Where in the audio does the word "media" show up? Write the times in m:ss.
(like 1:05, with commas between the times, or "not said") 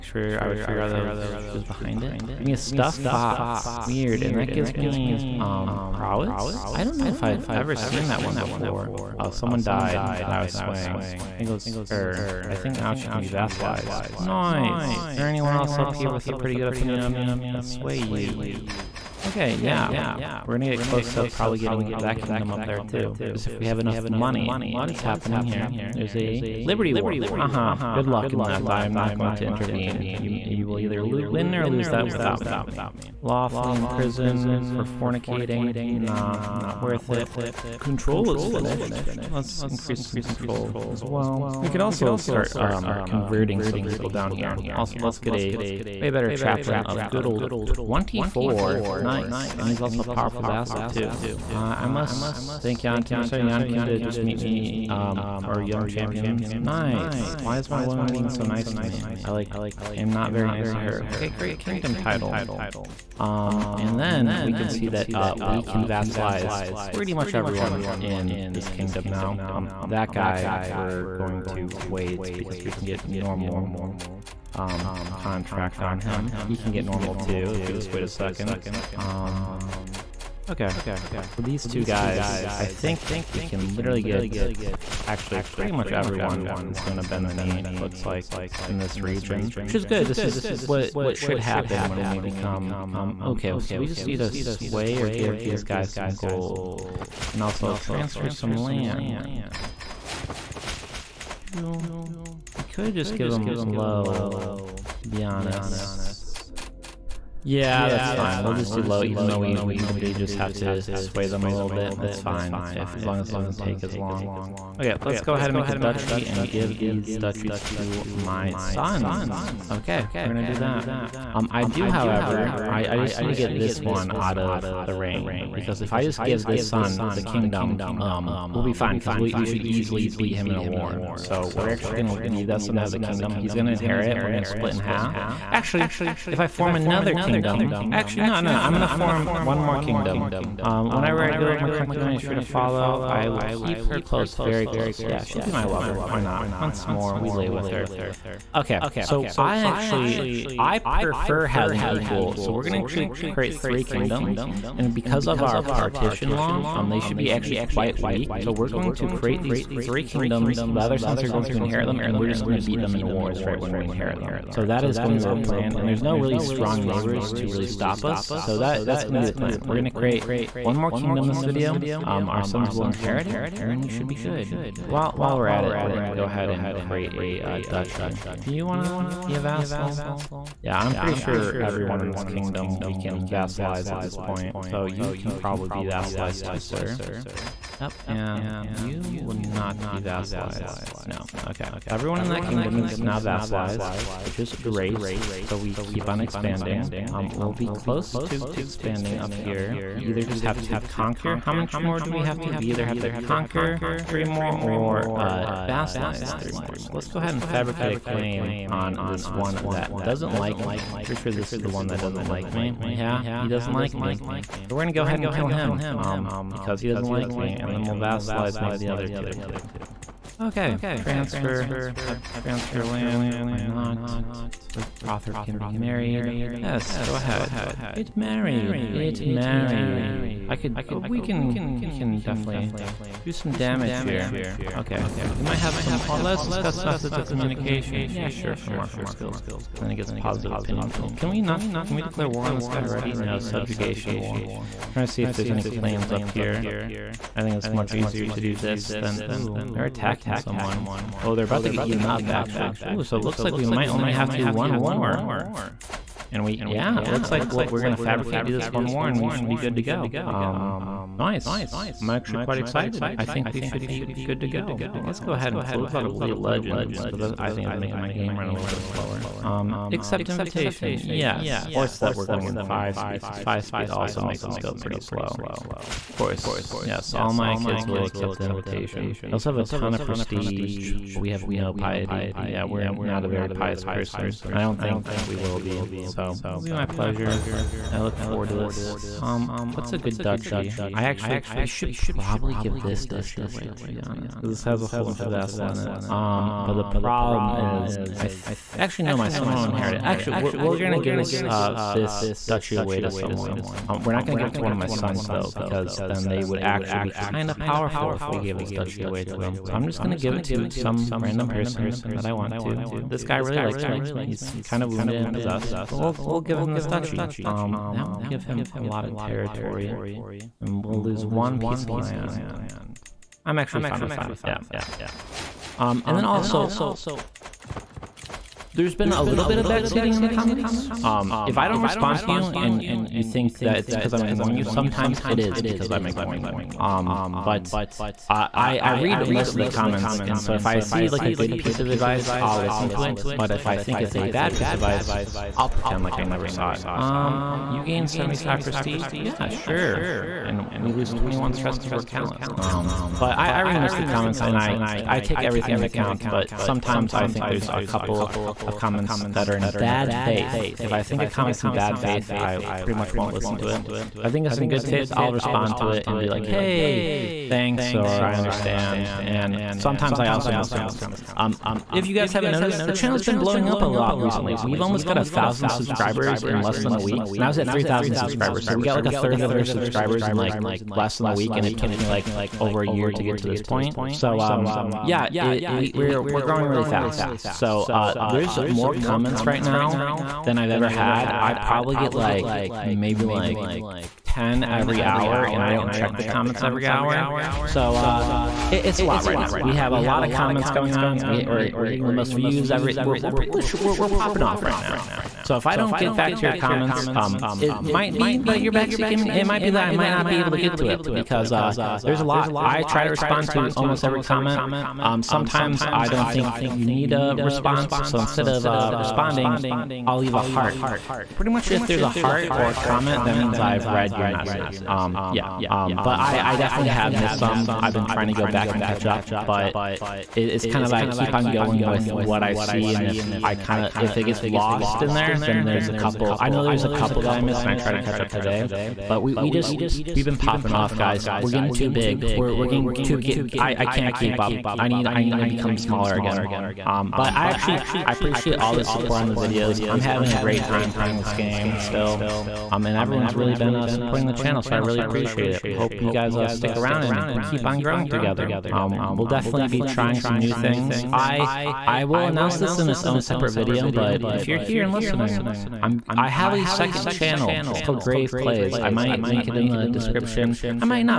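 not said.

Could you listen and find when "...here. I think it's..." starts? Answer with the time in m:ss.
4:06.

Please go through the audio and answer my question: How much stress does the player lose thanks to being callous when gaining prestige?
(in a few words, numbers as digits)
21.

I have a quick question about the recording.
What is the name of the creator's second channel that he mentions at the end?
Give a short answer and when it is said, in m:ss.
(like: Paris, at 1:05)
Grave Plays, at 7:48.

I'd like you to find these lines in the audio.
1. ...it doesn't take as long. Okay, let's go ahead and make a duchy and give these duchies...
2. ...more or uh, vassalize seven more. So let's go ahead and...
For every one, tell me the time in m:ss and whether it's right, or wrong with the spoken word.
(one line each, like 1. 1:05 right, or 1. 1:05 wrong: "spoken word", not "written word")
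1. 1:53 right
2. 3:24 wrong: "three", not "seven".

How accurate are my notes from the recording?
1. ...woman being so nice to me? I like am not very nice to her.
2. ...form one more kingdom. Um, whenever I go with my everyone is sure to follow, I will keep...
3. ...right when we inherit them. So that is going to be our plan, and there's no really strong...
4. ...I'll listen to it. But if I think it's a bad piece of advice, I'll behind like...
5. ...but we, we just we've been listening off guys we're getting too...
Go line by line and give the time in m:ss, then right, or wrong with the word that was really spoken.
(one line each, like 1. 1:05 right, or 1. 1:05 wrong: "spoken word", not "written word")
1. 0:57 right
2. 2:18 wrong: "concubine", not "everyone"
3. 2:43 right
4. 5:42 wrong: "pretend", not "behind"
5. 7:19 wrong: "popping", not "listening".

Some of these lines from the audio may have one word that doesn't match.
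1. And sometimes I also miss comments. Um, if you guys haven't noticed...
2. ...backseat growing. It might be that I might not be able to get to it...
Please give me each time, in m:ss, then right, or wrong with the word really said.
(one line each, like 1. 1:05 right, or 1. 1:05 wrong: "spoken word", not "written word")
1. 6:09 right
2. 6:48 wrong: "gaming", not "growing".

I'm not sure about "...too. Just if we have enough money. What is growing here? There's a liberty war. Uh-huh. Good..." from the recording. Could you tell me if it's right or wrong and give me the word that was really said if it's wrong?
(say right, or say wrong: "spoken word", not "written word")
wrong: "happening", not "growing".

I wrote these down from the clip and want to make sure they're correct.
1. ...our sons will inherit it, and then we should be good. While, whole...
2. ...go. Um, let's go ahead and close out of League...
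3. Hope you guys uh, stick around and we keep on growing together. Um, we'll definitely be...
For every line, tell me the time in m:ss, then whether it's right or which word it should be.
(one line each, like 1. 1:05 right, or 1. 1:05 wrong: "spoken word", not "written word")
1. 2:52 wrong: "while", not "whole"
2. 4:24 right
3. 7:35 right.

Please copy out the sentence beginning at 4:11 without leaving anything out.
Oh, they're about to get eaten up, actually.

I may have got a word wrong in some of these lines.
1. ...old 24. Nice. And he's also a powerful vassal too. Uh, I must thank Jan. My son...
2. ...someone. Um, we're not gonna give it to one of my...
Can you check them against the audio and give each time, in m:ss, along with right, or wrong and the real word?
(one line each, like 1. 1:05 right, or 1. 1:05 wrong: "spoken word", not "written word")
1. 0:47 right
2. 5:03 right.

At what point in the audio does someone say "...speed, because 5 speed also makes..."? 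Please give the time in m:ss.
4:32.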